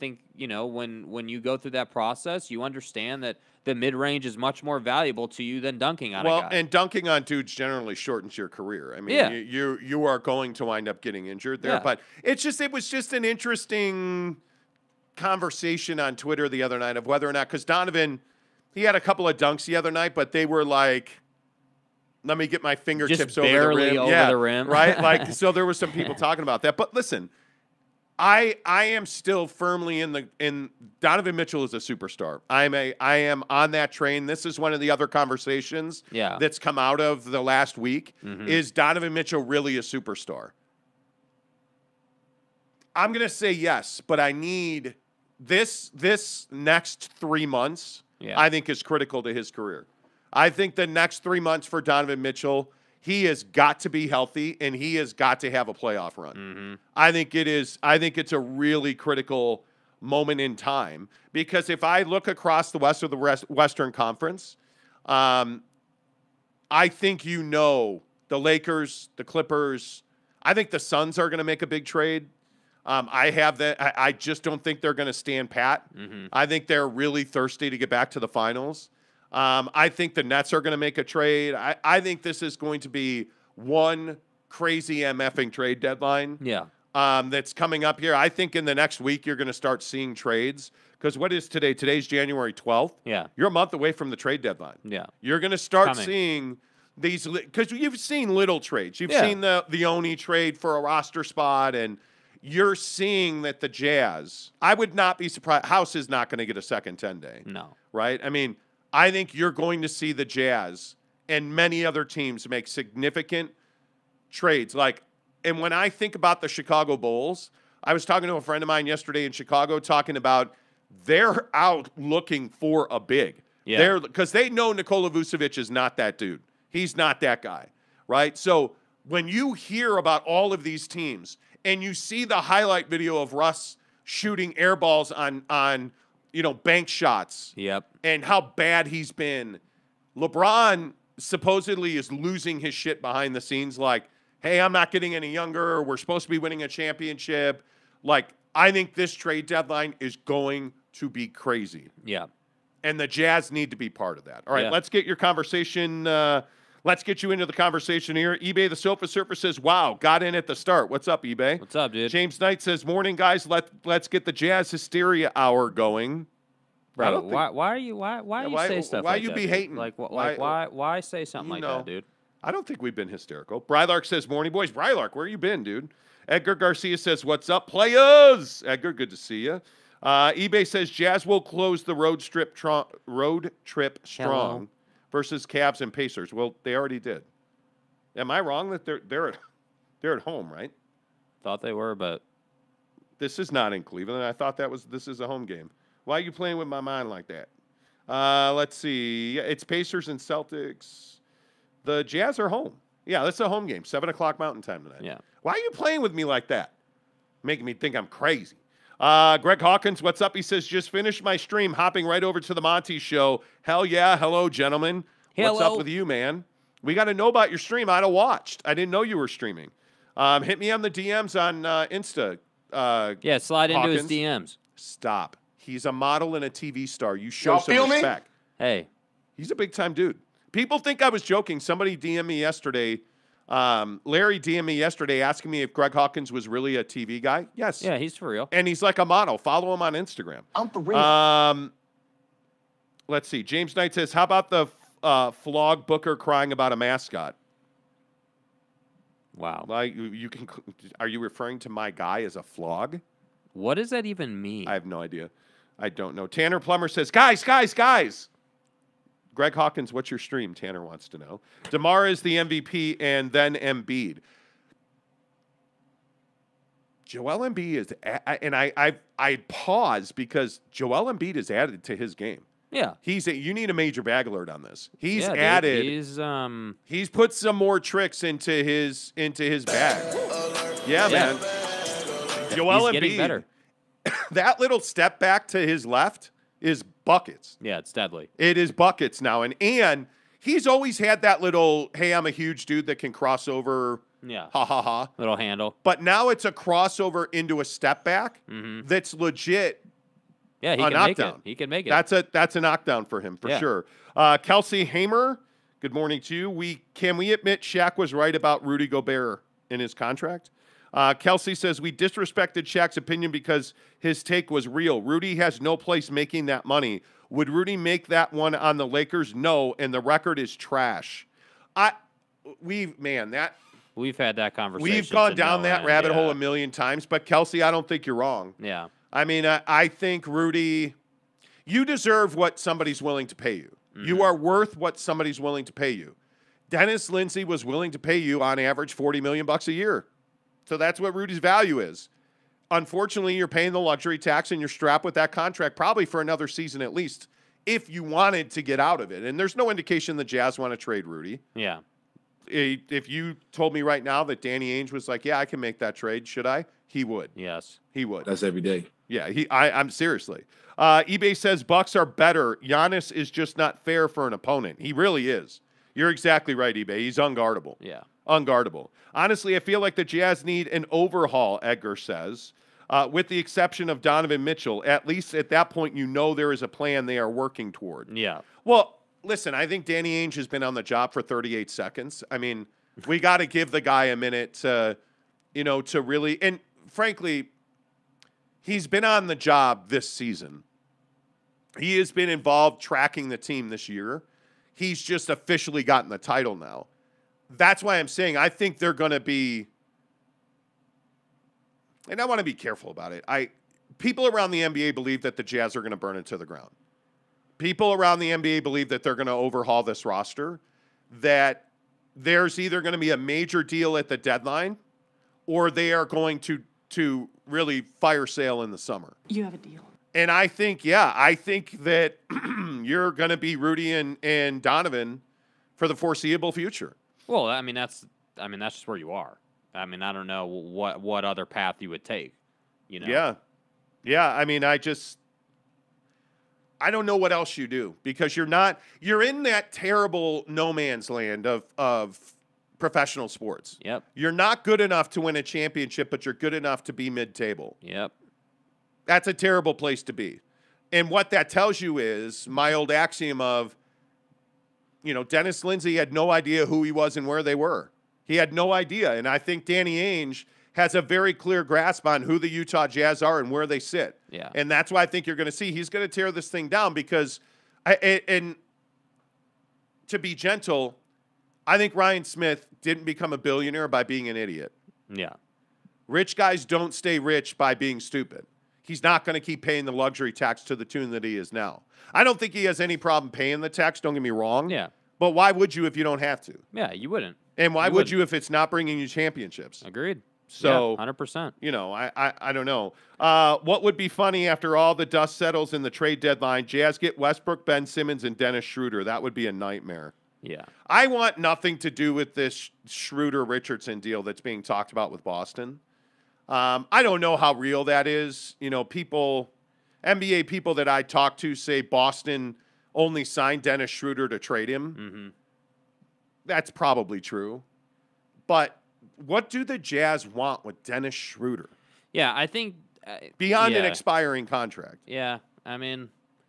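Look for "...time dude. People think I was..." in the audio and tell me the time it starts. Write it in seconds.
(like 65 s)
229 s.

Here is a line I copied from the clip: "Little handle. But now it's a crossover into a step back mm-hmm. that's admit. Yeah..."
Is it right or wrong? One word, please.
wrong.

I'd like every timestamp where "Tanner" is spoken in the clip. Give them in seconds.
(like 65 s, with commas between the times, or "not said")
256 s, 260 s.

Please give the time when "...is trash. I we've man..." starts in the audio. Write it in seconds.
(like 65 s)
320 s.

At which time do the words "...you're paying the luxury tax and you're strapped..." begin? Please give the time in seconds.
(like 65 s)
343 s.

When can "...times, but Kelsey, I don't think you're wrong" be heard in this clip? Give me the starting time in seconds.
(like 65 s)
326 s.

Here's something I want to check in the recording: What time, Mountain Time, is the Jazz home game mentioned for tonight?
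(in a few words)
7 o'clock.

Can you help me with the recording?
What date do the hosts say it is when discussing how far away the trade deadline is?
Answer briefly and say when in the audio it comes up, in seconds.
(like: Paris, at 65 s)
January 12th, at 92 s.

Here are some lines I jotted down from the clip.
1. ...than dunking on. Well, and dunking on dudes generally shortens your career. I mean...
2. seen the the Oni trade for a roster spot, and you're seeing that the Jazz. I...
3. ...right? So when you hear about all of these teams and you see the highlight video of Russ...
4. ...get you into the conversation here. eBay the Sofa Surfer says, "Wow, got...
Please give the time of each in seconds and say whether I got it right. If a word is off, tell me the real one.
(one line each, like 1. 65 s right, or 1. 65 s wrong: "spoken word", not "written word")
1. 5 s right
2. 99 s right
3. 128 s right
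4. 157 s right.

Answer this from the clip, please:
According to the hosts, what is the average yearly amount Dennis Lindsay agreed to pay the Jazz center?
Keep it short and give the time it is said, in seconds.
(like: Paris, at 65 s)
40 million, at 338 s.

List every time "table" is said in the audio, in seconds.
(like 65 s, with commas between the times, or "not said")
447 s.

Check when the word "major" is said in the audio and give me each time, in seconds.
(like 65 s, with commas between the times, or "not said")
273 s, 413 s.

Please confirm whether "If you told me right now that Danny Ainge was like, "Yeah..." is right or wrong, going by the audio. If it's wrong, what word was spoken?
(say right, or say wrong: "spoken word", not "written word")
right.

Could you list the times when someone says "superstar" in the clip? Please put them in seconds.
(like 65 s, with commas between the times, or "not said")
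31 s, 39 s.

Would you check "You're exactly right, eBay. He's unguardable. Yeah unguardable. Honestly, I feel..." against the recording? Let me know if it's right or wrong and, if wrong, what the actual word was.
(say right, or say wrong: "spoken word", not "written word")
right.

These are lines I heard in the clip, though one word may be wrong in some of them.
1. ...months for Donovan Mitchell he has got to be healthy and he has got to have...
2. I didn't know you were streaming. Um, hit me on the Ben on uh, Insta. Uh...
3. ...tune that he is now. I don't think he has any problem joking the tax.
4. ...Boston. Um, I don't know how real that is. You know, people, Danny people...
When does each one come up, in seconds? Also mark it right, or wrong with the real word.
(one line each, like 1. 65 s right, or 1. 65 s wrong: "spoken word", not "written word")
1. 51 s right
2. 218 s wrong: "DMs", not "Ben"
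3. 480 s wrong: "paying", not "joking"
4. 505 s wrong: "NBA", not "Danny".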